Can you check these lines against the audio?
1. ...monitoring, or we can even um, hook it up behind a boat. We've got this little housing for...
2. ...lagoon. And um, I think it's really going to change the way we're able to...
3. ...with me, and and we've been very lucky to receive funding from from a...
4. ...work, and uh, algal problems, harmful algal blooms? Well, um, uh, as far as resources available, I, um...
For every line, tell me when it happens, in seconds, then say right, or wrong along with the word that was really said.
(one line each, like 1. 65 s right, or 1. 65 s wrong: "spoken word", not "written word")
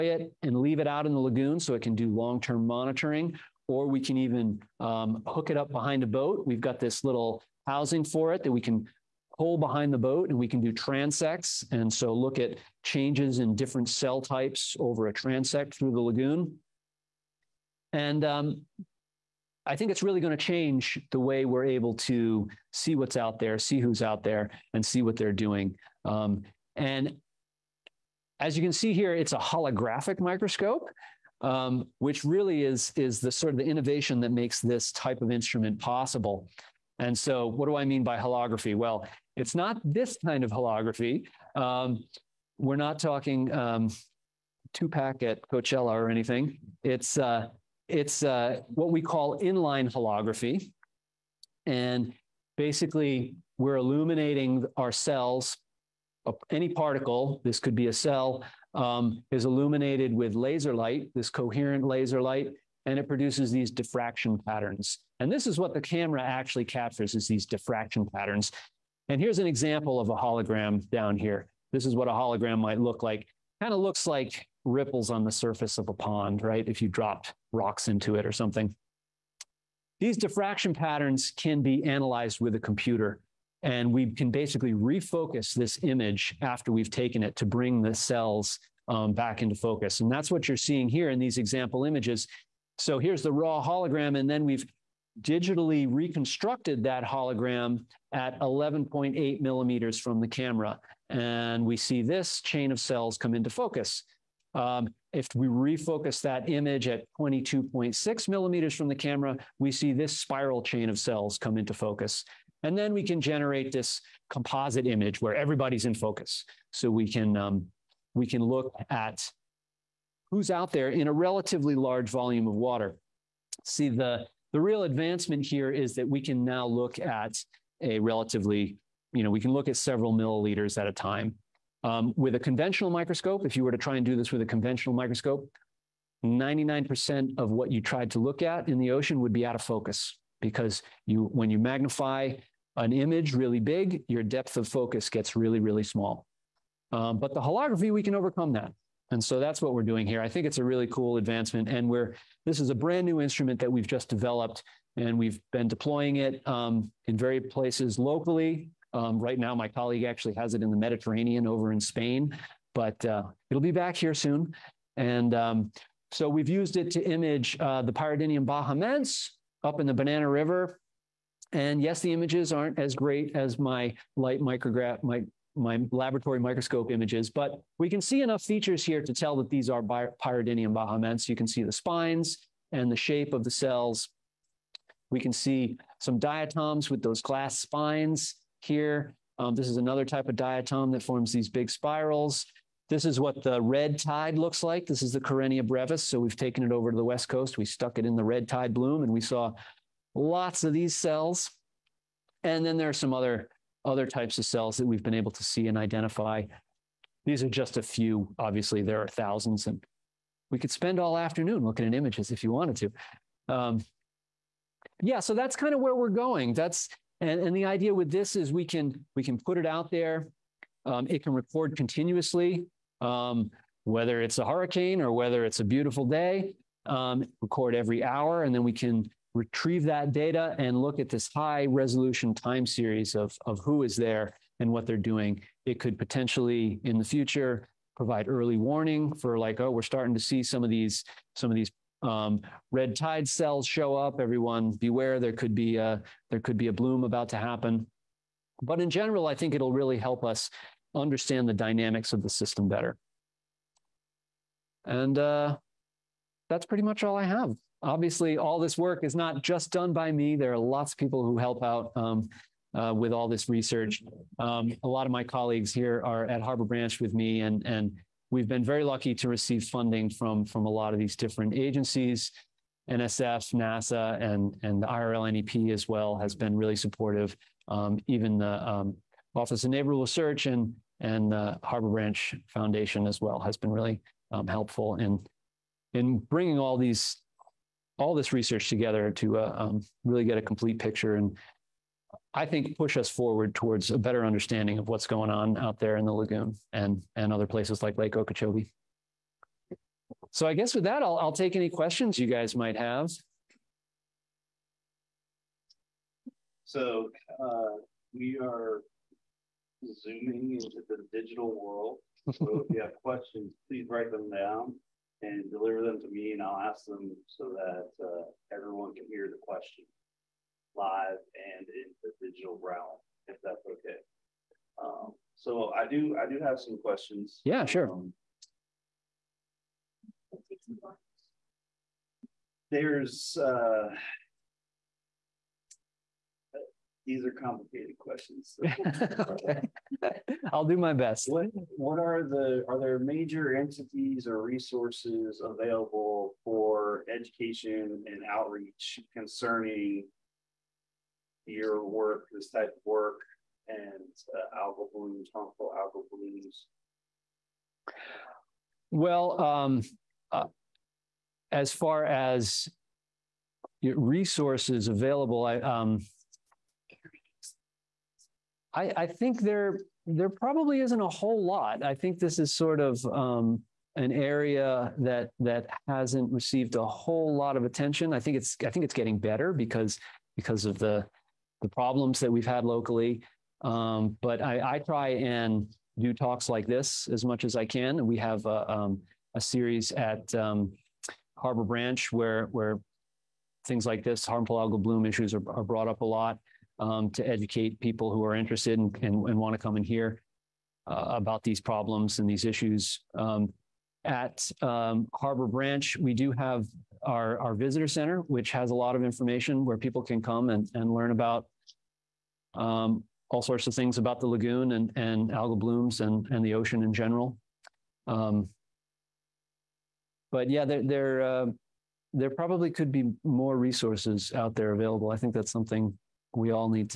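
1. 2 s right
2. 15 s right
3. 266 s right
4. 352 s wrong: "blooms", not "problems".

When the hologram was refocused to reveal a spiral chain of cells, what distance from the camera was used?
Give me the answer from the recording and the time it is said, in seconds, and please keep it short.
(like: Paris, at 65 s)
22.6 millimeters, at 107 s.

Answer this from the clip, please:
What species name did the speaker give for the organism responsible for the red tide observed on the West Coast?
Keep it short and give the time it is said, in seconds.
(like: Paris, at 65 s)
Karenia brevis, at 195 s.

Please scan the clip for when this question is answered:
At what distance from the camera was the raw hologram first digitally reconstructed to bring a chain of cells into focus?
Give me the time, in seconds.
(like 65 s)
98 s.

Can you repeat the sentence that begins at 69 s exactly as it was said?
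And here's an example of a hologram down here.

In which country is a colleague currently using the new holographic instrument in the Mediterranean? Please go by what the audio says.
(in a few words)
Spain.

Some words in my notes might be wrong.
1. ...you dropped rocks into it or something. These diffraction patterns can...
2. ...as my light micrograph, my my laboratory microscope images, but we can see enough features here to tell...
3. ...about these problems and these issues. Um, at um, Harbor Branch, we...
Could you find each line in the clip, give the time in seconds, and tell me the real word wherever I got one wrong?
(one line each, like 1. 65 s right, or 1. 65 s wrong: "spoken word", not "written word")
1. 76 s right
2. 173 s right
3. 401 s right.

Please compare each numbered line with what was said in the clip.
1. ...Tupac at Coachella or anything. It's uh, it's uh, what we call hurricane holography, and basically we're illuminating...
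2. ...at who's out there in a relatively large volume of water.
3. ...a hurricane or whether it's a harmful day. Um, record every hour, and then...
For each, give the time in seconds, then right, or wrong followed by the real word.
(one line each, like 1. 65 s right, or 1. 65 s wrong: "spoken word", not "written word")
1. 44 s wrong: "inline", not "hurricane"
2. 118 s right
3. 224 s wrong: "beautiful", not "harmful".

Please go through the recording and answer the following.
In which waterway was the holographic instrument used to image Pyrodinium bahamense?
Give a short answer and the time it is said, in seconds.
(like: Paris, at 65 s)
Banana River, at 169 s.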